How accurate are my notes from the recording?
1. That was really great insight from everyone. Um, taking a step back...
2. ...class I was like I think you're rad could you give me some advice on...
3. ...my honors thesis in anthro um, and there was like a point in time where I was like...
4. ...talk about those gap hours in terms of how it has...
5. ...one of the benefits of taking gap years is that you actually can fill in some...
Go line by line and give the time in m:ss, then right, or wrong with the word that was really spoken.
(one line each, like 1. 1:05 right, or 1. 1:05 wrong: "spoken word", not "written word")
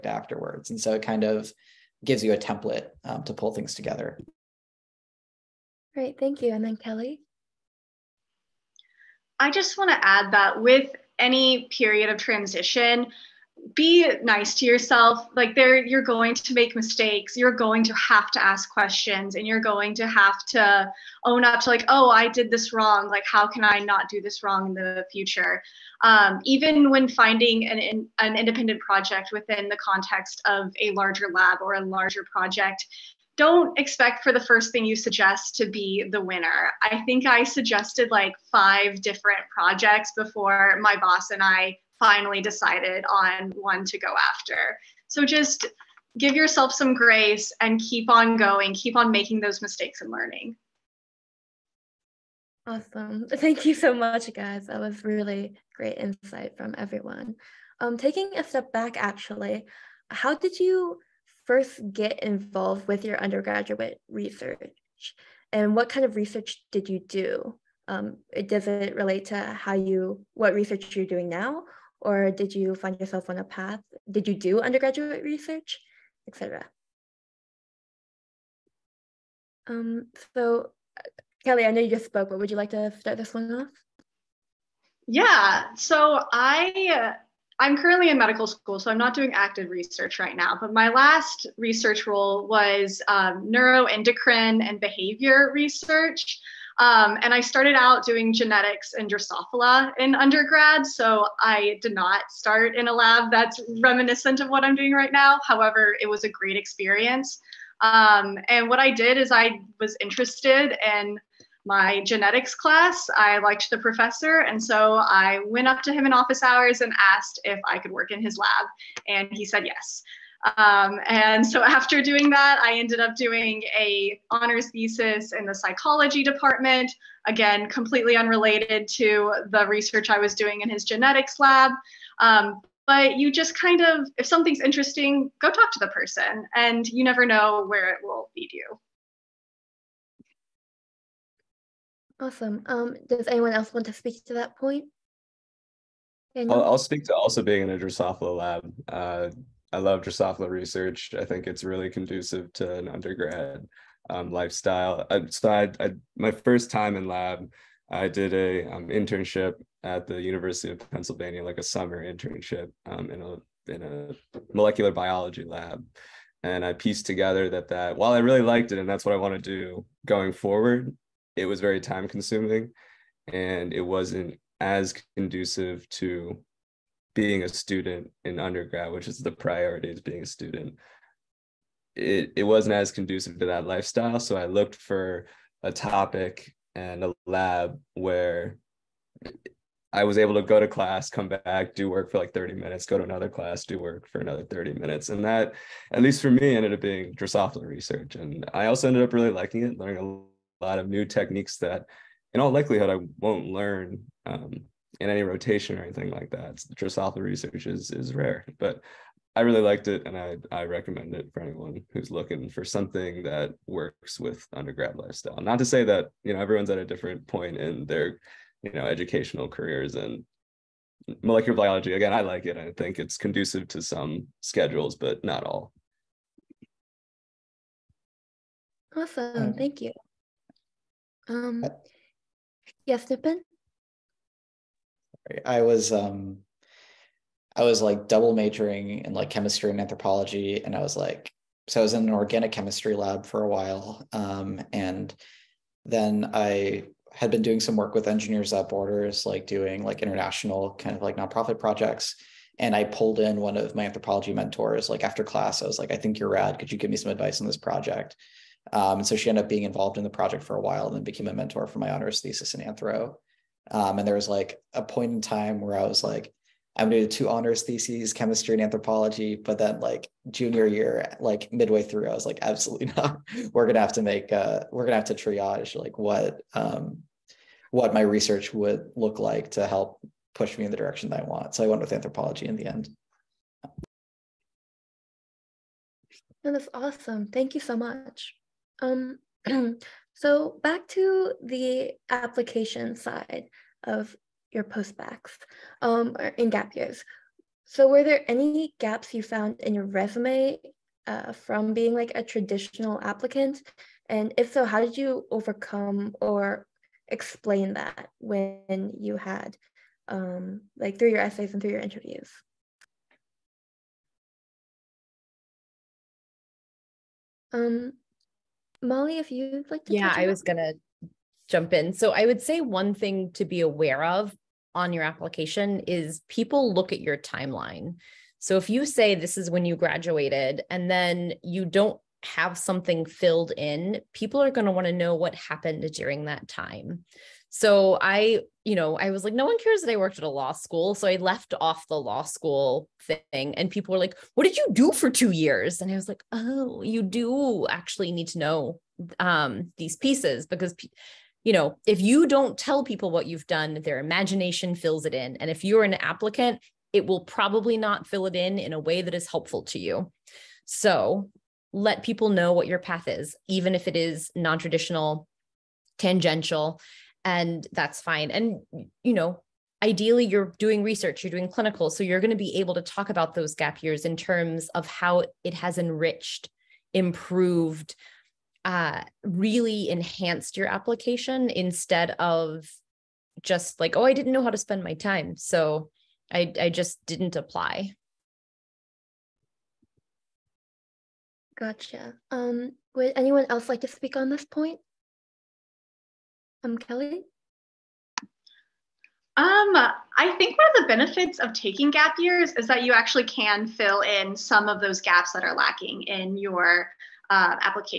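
1. 0:54 right
2. 4:15 right
3. 4:21 right
4. 6:12 wrong: "years", not "hours"
5. 6:40 right.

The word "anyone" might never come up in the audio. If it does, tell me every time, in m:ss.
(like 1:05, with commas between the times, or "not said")
2:23, 3:31, 6:33.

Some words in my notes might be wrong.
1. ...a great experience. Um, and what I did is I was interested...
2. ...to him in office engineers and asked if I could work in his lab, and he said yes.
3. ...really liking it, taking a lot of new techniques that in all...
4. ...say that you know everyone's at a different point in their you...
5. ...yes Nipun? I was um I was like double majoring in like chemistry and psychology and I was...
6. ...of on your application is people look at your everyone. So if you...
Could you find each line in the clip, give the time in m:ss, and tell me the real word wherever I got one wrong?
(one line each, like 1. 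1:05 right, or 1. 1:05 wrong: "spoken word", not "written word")
1. 1:46 right
2. 1:55 wrong: "hours", not "engineers"
3. 3:19 wrong: "learning", not "taking"
4. 3:35 right
5. 3:52 wrong: "anthropology", not "psychology"
6. 5:24 wrong: "timeline", not "everyone".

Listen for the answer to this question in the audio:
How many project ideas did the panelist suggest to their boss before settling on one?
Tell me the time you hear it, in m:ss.
0:38.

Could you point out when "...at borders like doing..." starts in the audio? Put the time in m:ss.
4:08.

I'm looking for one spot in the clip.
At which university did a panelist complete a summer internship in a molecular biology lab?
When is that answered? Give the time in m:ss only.
2:40.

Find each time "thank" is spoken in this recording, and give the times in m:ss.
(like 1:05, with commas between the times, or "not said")
0:06, 0:53, 3:49, 4:47.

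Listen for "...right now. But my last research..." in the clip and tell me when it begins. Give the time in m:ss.
1:30.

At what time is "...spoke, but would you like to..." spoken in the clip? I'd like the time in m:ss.
1:22.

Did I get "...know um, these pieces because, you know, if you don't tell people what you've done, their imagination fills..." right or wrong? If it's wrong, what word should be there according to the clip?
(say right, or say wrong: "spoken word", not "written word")
right.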